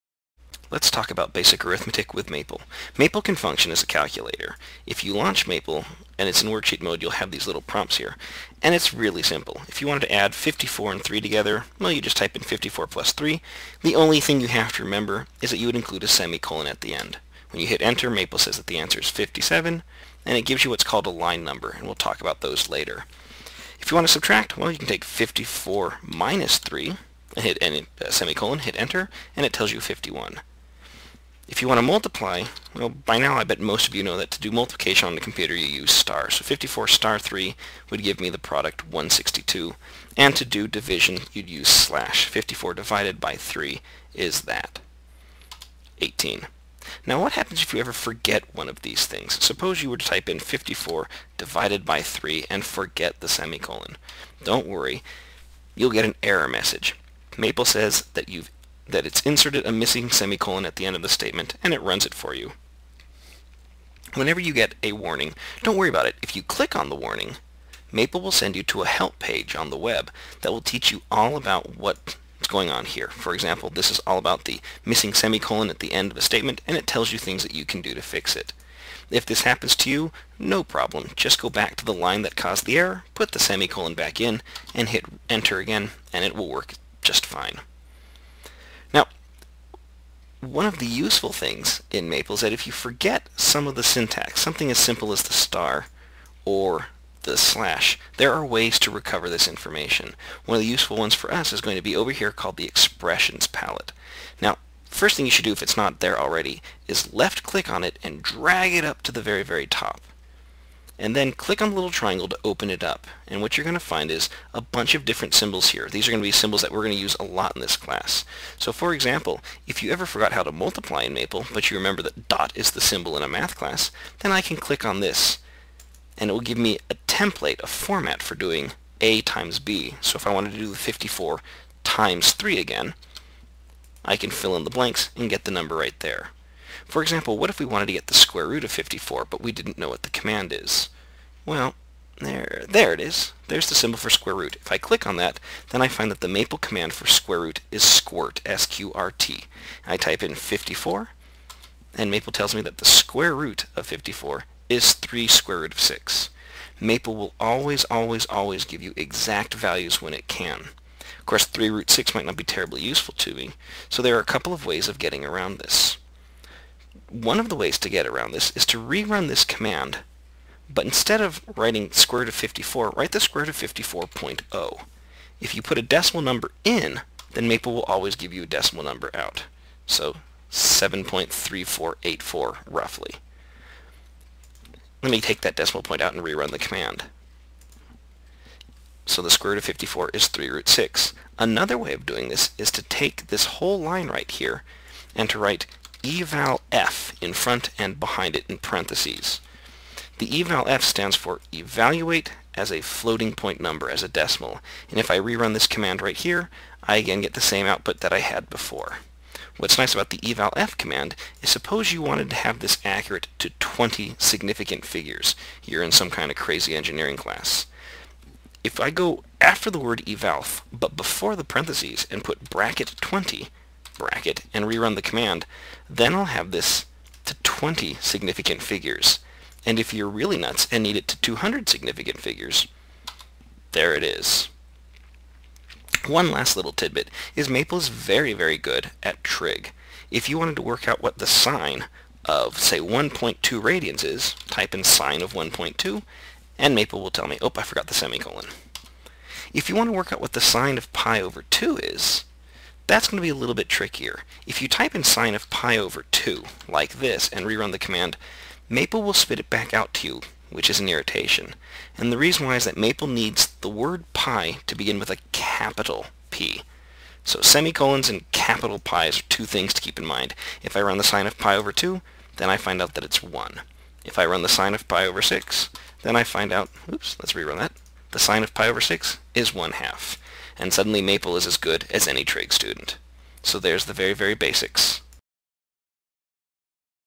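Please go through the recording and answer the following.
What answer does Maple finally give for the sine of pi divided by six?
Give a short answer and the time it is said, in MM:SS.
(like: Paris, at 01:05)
1 half, at 04:39.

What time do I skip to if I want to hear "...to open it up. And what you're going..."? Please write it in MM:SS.
01:52.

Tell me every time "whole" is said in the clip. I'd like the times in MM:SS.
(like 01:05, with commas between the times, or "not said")
03:13.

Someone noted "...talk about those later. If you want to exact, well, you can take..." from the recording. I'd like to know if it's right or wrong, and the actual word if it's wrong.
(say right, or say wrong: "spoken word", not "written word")
wrong: "subtract", not "exact".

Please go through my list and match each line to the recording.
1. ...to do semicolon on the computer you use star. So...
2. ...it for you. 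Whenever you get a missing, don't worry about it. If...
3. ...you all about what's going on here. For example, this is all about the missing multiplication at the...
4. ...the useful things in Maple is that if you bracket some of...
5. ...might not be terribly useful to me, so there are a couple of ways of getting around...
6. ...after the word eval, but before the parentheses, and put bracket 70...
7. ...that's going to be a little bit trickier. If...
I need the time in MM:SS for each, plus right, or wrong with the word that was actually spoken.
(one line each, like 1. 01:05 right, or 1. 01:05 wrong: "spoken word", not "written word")
1. 00:34 wrong: "multiplication", not "semicolon"
2. 01:02 wrong: "warning", not "missing"
3. 01:10 wrong: "semicolon", not "multiplication"
4. 01:30 wrong: "forget", not "bracket"
5. 02:42 right
6. 03:39 wrong: "20", not "70"
7. 04:12 right.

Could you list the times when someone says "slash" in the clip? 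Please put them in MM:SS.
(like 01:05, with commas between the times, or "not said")
00:41, 01:37.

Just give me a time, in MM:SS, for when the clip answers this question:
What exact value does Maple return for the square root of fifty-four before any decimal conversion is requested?
02:34.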